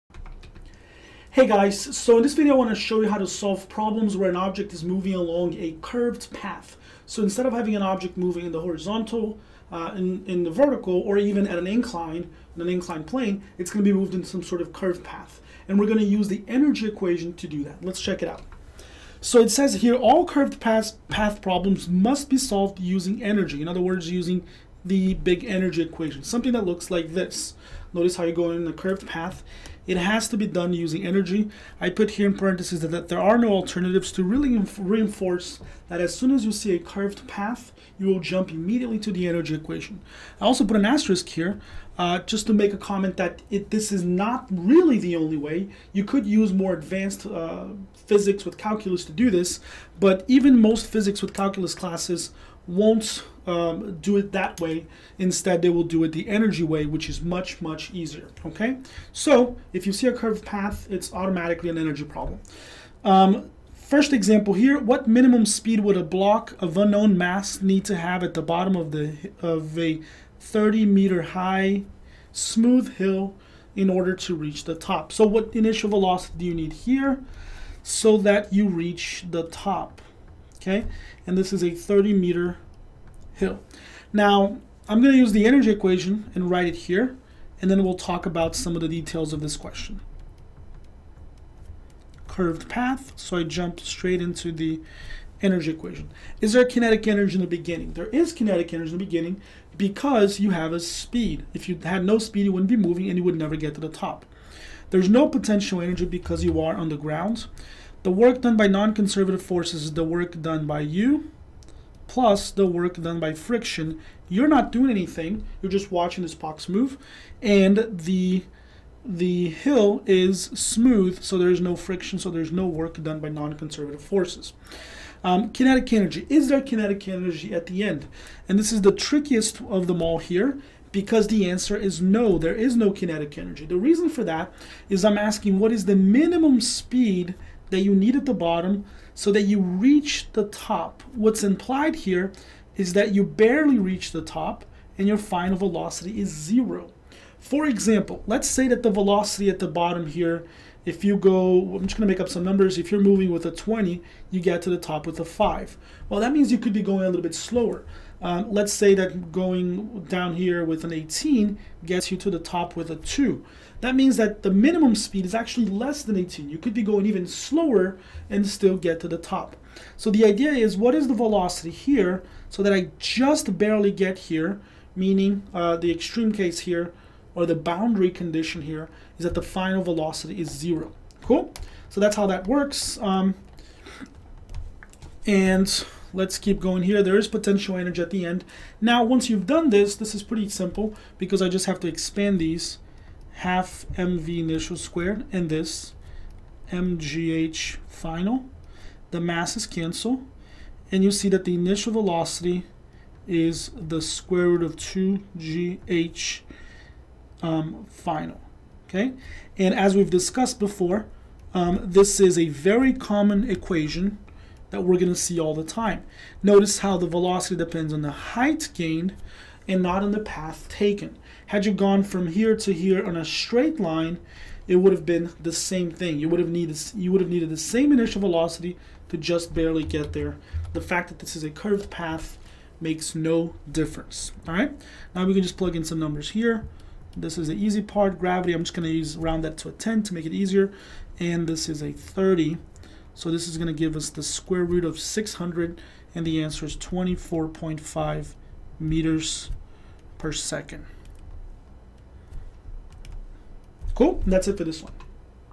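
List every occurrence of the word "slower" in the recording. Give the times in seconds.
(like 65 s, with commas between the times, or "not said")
157 s, 167 s.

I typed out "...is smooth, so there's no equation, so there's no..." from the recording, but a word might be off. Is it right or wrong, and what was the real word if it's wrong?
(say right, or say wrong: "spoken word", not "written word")
wrong: "friction", not "equation".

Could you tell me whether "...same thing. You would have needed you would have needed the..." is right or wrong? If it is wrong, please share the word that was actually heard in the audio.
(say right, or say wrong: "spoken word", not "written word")
right.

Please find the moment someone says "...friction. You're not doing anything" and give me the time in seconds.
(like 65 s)
113 s.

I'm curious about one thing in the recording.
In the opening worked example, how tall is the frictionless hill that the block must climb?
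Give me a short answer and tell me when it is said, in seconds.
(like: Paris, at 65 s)
30 meters, at 70 s.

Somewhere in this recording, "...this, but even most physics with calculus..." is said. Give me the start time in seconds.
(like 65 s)
49 s.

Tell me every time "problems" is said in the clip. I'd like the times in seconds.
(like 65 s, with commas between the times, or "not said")
3 s, 21 s, 62 s.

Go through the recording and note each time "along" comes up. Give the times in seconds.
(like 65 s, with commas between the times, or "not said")
5 s.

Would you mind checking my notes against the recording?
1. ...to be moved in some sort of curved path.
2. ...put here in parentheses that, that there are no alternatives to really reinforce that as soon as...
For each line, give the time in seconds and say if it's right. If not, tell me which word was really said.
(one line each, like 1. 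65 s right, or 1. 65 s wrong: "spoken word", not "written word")
1. 13 s right
2. 31 s right.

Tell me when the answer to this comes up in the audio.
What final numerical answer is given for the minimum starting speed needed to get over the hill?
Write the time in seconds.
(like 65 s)
246 s.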